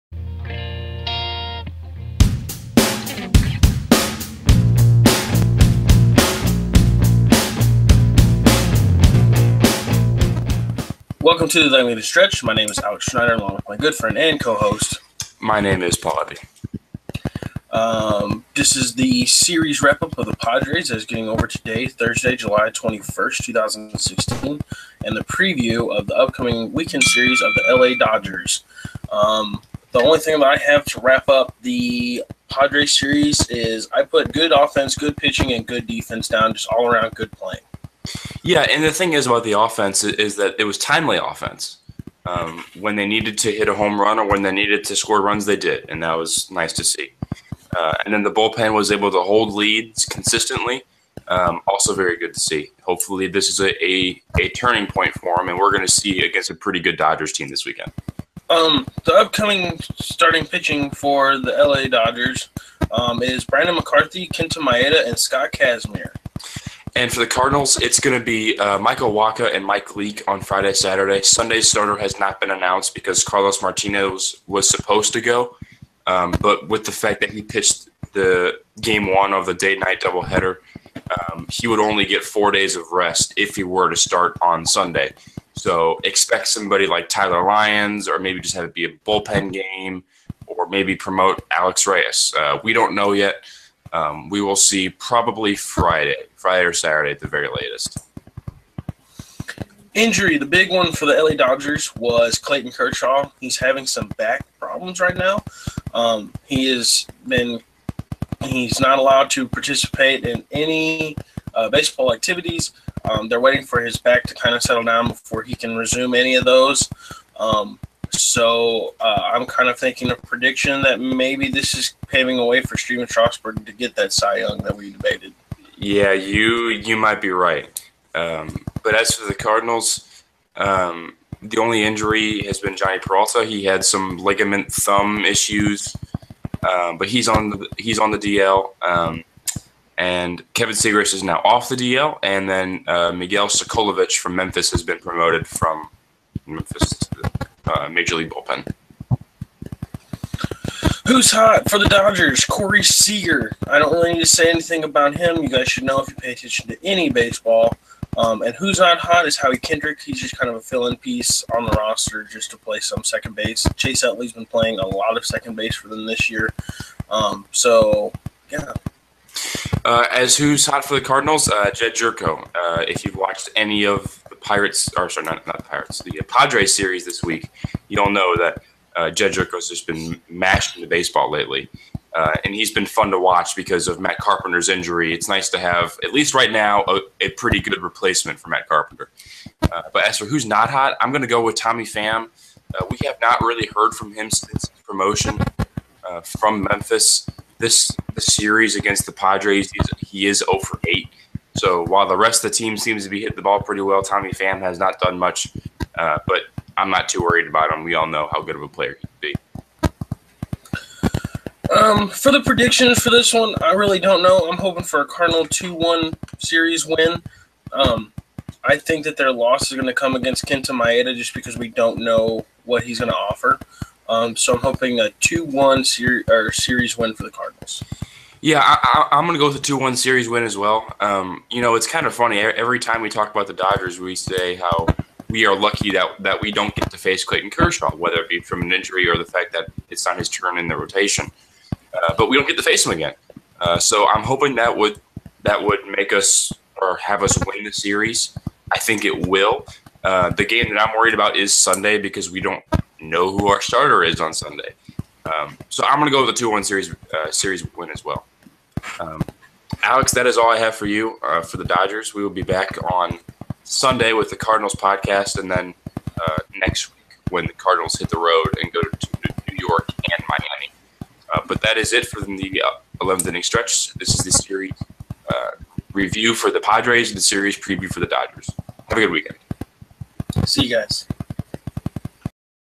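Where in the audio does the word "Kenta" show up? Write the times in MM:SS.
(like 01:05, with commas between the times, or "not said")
01:04, 03:40.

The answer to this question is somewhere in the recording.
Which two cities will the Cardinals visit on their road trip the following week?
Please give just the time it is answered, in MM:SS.
04:29.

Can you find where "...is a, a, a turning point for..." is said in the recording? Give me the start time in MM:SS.
00:53.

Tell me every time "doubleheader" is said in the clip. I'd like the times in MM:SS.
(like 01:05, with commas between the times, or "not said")
01:20.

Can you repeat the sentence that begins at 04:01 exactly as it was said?
Uh, but we don't get to face him again.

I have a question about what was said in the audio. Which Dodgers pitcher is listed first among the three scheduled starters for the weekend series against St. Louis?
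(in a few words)
Brandon McCarthy.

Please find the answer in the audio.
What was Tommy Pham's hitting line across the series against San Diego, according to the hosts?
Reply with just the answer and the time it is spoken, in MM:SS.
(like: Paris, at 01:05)
0 for 8, at 03:20.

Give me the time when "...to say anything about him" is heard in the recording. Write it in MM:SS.
02:34.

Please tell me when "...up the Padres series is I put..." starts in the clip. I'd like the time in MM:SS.
00:31.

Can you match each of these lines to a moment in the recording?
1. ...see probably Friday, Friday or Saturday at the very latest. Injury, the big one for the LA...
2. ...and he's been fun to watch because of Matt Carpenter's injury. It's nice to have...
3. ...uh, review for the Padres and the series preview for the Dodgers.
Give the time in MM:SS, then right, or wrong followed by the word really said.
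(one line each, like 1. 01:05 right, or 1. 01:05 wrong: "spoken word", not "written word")
1. 01:34 right
2. 03:02 right
3. 04:35 right.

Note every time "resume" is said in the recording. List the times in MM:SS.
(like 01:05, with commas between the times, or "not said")
01:55.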